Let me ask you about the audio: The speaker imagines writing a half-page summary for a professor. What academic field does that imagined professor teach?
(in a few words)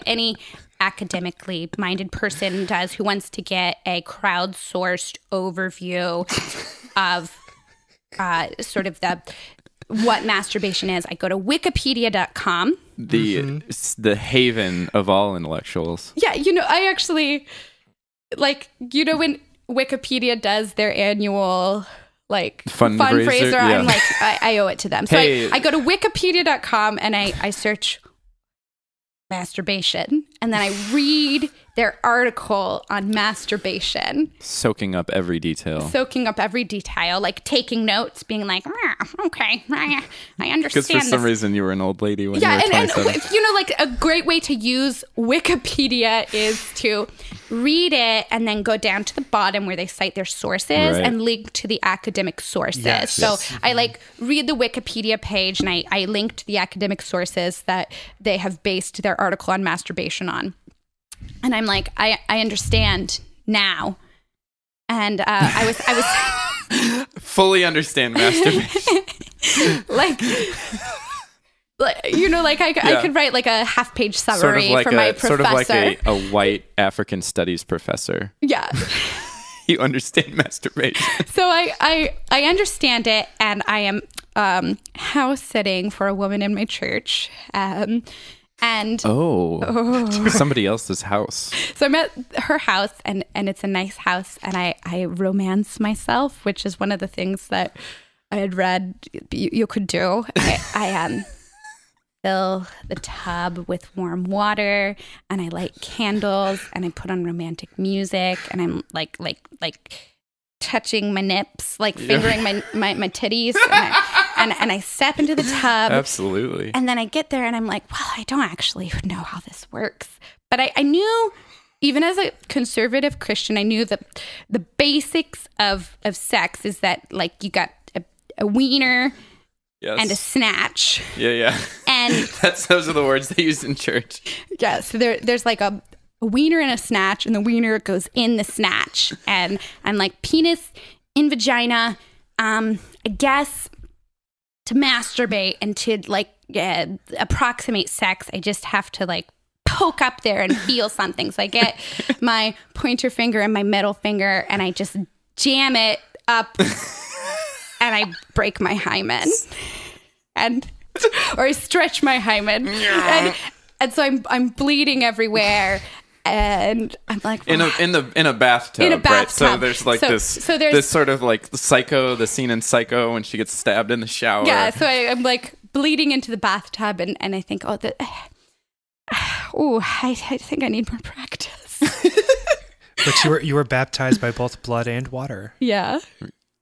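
African studies.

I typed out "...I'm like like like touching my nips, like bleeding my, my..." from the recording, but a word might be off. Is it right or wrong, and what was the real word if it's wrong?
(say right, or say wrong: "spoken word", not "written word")
wrong: "fingering", not "bleeding".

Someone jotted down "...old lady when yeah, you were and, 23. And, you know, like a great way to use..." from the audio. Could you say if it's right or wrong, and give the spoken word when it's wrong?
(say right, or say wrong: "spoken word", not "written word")
wrong: "27", not "23".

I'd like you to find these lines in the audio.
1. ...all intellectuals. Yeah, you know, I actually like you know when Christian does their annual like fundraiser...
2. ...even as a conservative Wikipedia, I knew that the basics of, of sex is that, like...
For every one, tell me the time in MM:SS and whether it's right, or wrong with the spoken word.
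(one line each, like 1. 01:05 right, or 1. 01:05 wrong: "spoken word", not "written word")
1. 00:15 wrong: "Wikipedia", not "Christian"
2. 02:01 wrong: "Christian", not "Wikipedia".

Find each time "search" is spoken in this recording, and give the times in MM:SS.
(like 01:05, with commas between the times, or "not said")
00:27.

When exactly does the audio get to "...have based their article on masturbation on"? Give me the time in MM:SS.
00:58.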